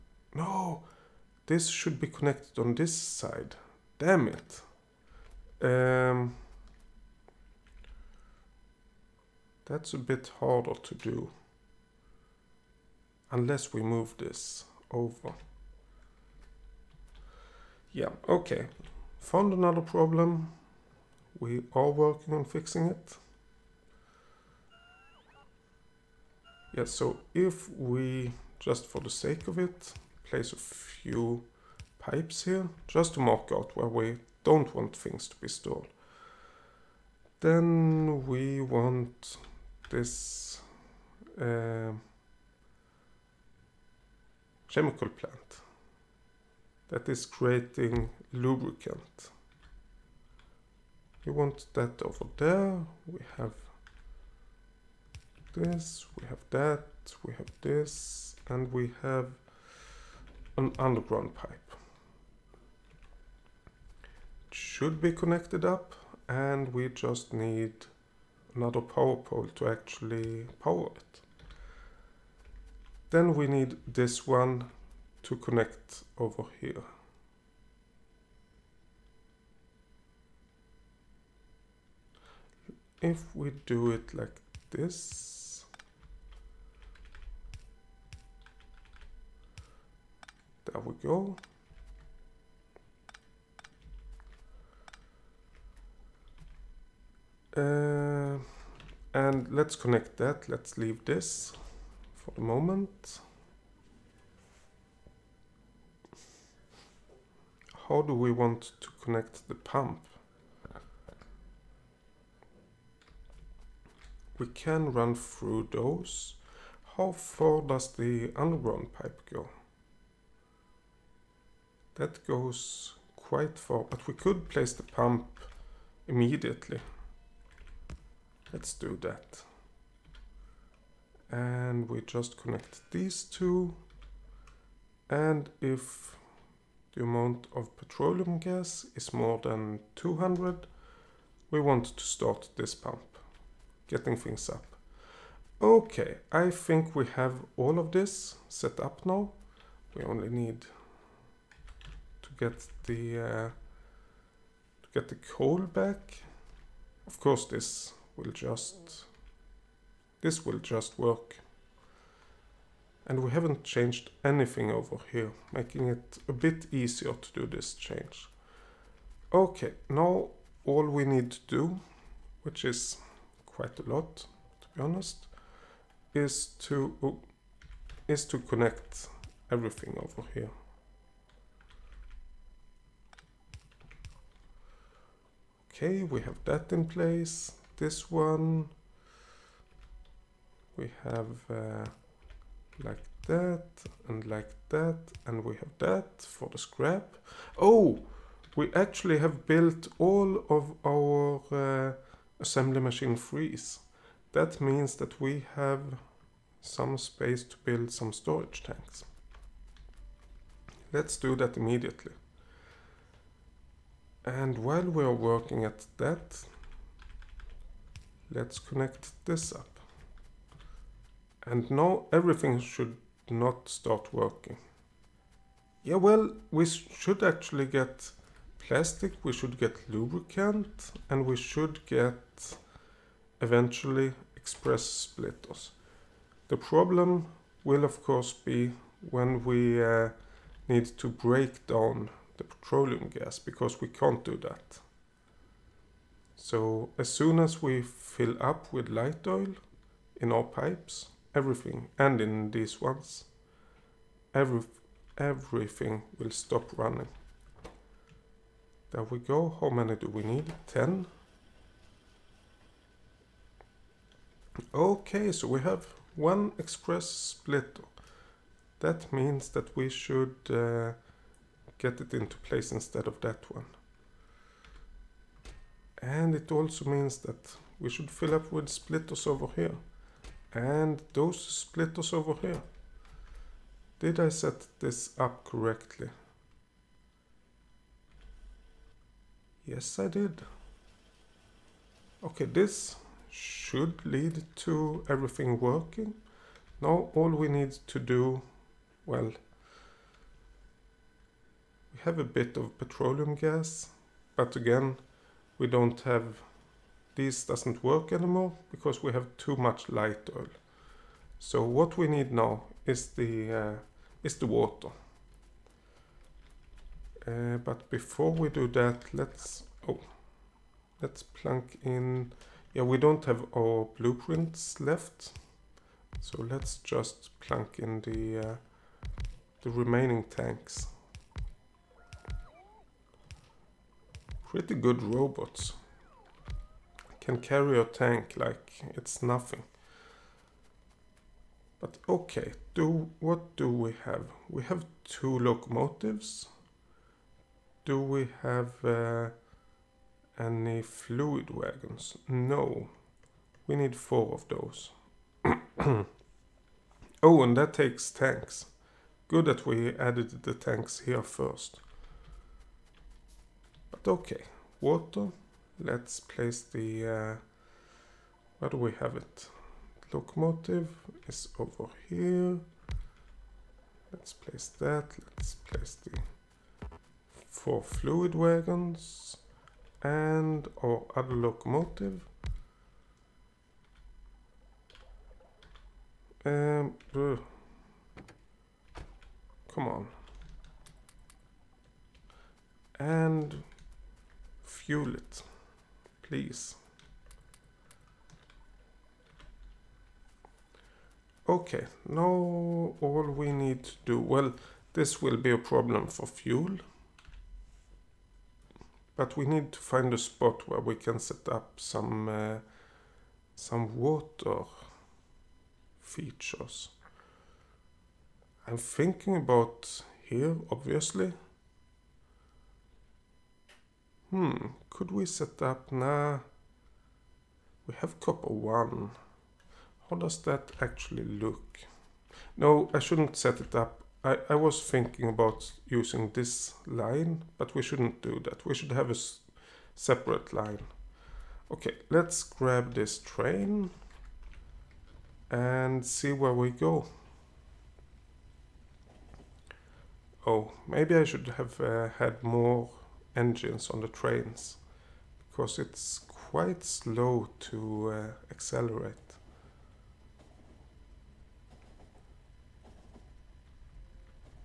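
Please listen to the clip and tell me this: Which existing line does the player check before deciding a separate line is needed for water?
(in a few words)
Copper 1.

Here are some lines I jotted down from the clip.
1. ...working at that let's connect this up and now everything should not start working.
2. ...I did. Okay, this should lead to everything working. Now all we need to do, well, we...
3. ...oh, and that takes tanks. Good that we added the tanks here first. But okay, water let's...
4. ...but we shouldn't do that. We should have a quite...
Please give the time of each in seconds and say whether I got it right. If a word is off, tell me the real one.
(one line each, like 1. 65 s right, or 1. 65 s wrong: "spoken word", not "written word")
1. 215 s right
2. 289 s right
3. 357 s right
4. 437 s wrong: "separate", not "quite".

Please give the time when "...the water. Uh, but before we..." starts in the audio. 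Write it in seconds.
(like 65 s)
314 s.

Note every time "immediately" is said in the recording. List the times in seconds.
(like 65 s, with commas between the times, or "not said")
126 s, 211 s.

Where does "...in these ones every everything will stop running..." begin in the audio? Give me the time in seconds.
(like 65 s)
252 s.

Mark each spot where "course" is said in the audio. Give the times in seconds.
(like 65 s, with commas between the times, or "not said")
157 s, 238 s.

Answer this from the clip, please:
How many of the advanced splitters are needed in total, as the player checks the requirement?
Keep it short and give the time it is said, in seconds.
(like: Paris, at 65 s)
10, at 260 s.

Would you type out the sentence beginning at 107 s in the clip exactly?
how do we want to connect the pump?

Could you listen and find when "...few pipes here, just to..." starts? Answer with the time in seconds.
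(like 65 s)
30 s.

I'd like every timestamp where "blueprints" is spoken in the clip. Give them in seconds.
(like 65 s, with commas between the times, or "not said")
323 s.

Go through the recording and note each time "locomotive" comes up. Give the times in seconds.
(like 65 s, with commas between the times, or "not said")
345 s, 370 s, 381 s.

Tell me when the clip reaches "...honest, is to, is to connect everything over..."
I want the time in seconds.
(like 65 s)
174 s.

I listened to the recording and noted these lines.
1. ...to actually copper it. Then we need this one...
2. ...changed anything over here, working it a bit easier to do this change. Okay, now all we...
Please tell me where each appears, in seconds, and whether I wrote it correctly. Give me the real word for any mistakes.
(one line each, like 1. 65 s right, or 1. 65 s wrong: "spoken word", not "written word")
1. 69 s wrong: "power", not "copper"
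2. 163 s wrong: "making", not "working".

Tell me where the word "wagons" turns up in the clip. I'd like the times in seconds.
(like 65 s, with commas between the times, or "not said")
351 s, 378 s.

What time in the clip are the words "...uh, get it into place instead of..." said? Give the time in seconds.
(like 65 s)
270 s.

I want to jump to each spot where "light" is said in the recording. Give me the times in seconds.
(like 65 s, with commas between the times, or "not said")
248 s, 309 s.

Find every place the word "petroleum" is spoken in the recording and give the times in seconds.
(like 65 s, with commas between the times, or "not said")
137 s, 242 s, 302 s.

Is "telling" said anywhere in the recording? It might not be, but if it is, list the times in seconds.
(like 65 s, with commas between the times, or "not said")
not said.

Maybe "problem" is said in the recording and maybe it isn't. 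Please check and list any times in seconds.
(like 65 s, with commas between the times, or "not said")
19 s, 236 s, 405 s.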